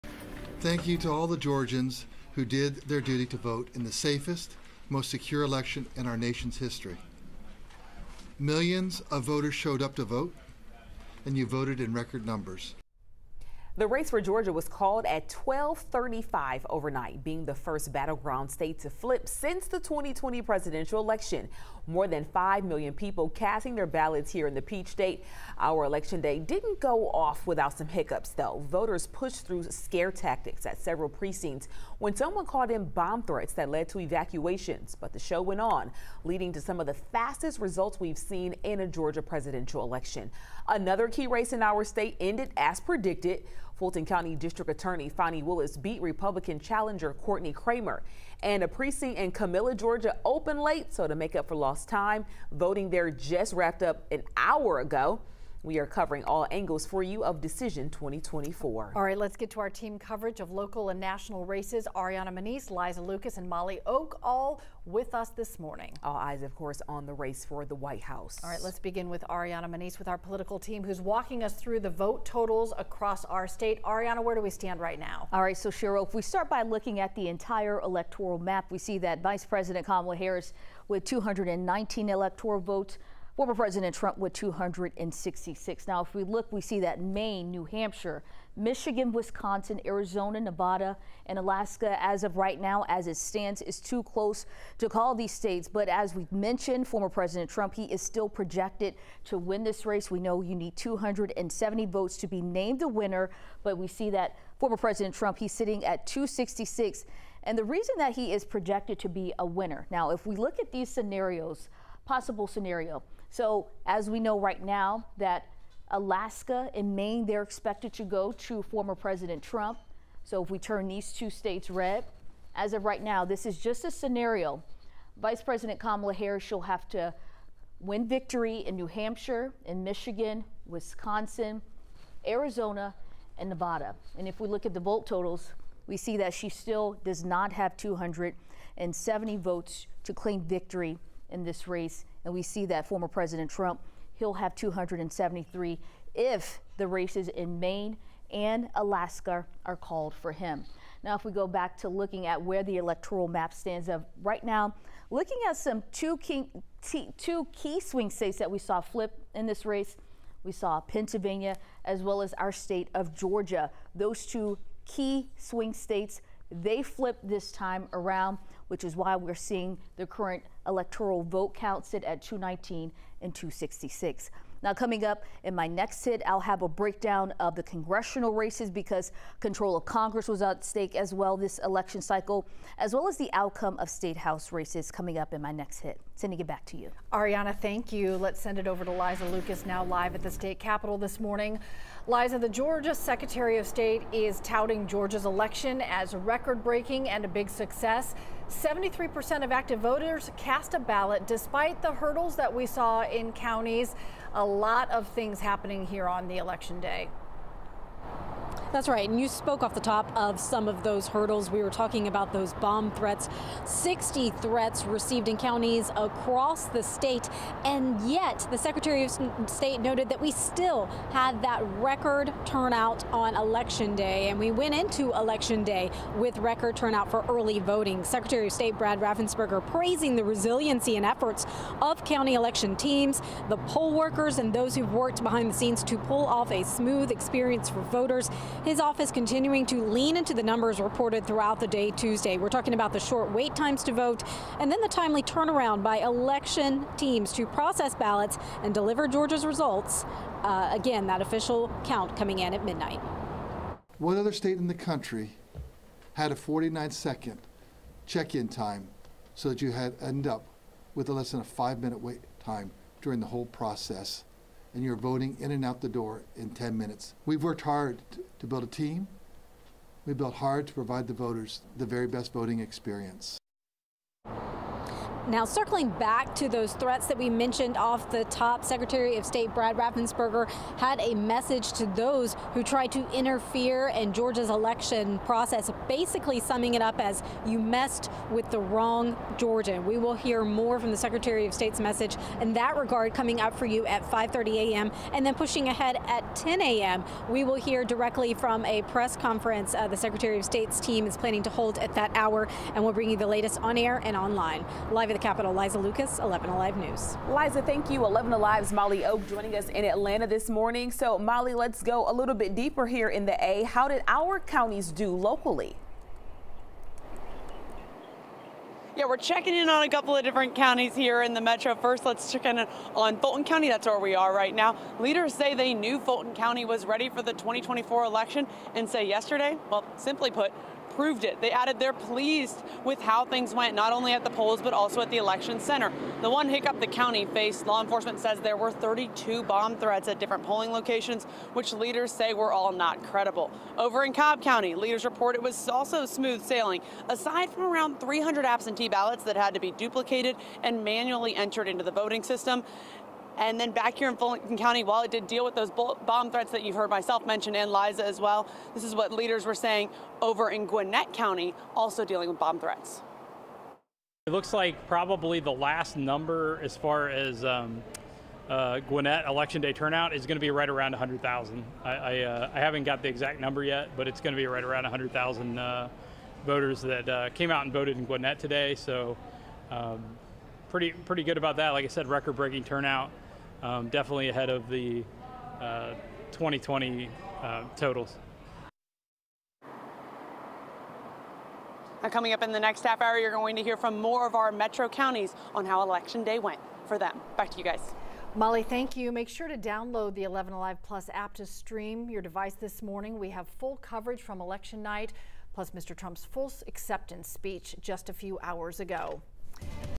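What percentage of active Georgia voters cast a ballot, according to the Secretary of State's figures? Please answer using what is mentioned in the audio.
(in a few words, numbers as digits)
73%.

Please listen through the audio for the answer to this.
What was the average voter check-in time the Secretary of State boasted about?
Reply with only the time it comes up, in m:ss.
4:16.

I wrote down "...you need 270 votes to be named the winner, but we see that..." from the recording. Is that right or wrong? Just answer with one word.
right.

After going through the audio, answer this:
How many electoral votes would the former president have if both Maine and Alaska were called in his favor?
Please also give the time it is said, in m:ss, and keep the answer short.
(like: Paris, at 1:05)
273, at 2:24.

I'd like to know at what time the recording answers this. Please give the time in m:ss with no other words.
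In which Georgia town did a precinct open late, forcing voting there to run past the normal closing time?
0:49.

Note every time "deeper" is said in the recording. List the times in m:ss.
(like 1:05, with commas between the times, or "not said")
5:12.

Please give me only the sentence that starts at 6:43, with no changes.
We have full coverage from election night, plus Mr.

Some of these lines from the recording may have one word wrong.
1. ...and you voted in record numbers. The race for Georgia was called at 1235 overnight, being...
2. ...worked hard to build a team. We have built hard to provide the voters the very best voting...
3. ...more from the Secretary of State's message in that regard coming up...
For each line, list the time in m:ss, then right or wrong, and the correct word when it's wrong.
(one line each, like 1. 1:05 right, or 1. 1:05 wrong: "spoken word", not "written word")
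1. 0:11 right
2. 4:27 right
3. 4:50 right.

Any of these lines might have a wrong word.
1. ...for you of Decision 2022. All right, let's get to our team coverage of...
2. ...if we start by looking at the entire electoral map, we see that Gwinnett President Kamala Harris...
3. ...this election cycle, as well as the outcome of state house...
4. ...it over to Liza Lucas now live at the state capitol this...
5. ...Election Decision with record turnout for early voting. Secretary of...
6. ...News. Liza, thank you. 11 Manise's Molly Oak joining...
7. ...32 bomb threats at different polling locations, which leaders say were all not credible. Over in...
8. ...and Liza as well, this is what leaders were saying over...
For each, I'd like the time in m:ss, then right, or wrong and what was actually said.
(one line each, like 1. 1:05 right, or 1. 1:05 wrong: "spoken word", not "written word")
1. 0:56 wrong: "2024", not "2022"
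2. 1:16 wrong: "Vice", not "Gwinnett"
3. 3:01 right
4. 3:08 right
5. 3:45 wrong: "Day", not "Decision"
6. 5:06 wrong: "Alive", not "Manise"
7. 5:38 right
8. 5:57 right.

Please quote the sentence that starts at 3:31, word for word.
We were talking about those bomb threats.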